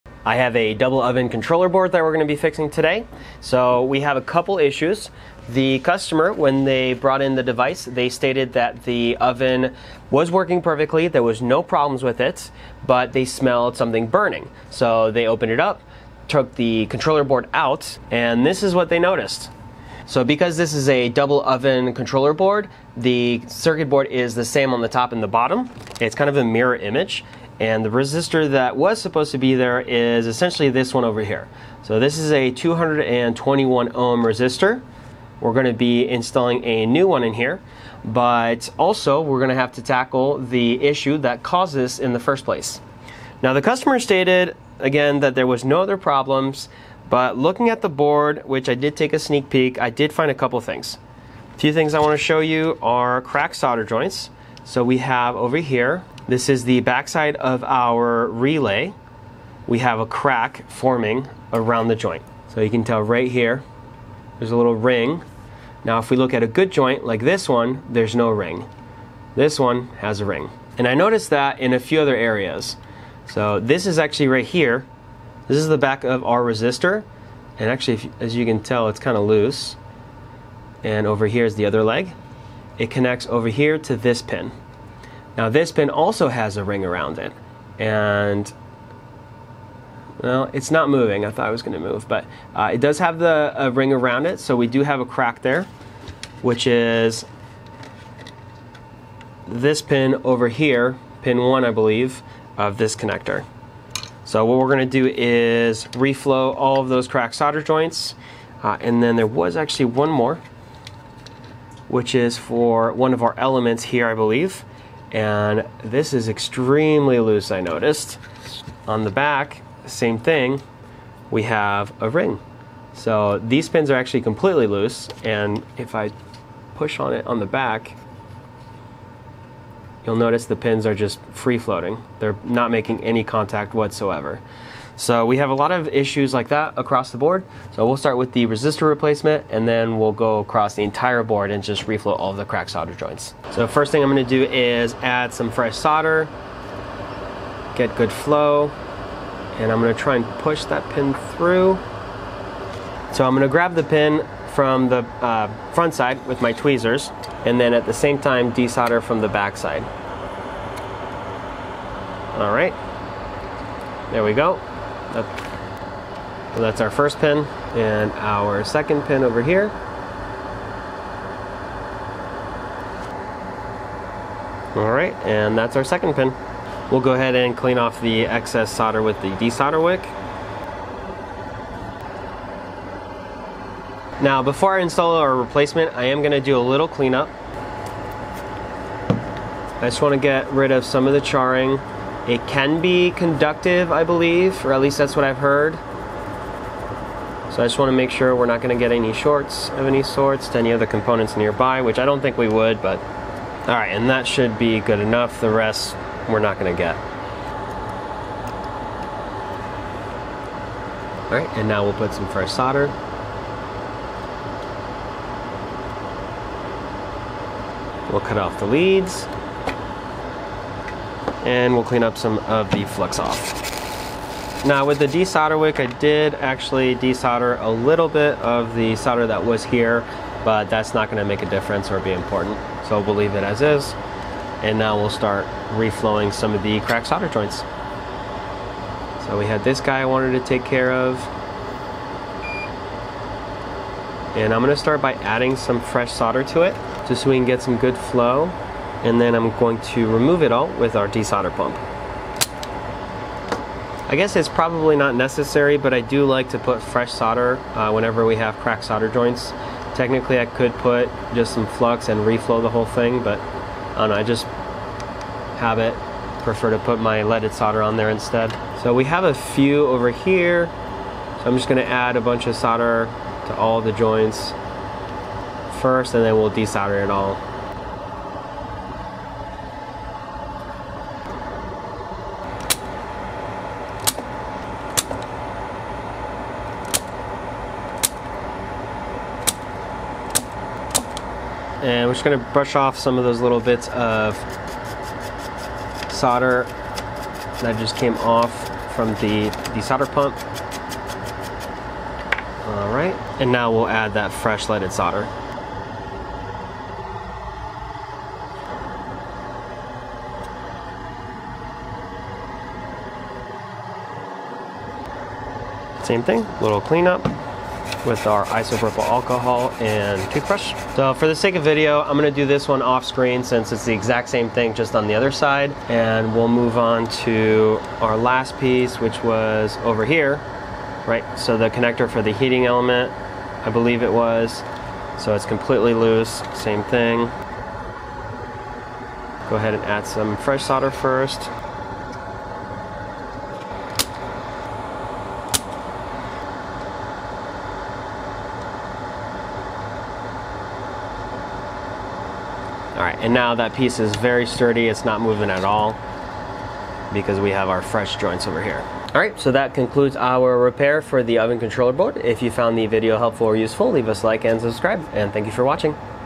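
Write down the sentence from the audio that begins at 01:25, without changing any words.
Now this pin also has a ring around it, and well, it's not moving.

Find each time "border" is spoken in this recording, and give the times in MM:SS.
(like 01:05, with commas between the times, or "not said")
not said.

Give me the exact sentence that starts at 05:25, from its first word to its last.
And we'll move on to our last piece, which was over here, right?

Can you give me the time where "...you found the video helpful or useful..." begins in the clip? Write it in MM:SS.
06:02.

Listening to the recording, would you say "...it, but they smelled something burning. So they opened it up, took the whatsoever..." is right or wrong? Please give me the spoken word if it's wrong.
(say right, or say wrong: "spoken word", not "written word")
wrong: "controller", not "whatsoever".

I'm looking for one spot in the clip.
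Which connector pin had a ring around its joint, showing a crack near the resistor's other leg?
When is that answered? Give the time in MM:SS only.
01:41.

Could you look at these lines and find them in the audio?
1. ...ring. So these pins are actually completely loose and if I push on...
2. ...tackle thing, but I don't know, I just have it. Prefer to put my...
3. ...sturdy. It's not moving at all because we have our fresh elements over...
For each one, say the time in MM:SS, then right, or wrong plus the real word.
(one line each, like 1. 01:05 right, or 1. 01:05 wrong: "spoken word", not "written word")
1. 02:02 right
2. 04:22 wrong: "whole", not "tackle"
3. 05:54 wrong: "joints", not "elements".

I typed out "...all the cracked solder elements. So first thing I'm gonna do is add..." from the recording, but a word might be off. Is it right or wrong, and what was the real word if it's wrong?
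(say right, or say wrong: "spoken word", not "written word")
wrong: "joints", not "elements".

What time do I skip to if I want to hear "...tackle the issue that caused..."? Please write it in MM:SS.
00:39.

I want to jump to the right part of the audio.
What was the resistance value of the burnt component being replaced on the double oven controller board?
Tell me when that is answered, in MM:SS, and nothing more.
00:32.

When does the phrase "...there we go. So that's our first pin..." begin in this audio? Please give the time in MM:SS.
02:44.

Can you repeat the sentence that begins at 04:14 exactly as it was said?
I guess it's probably not necessary, but I do like to put fresh solder uh, whenever we have cracked solder joints.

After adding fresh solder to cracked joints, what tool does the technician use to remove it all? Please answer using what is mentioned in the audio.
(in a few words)
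desolder pump.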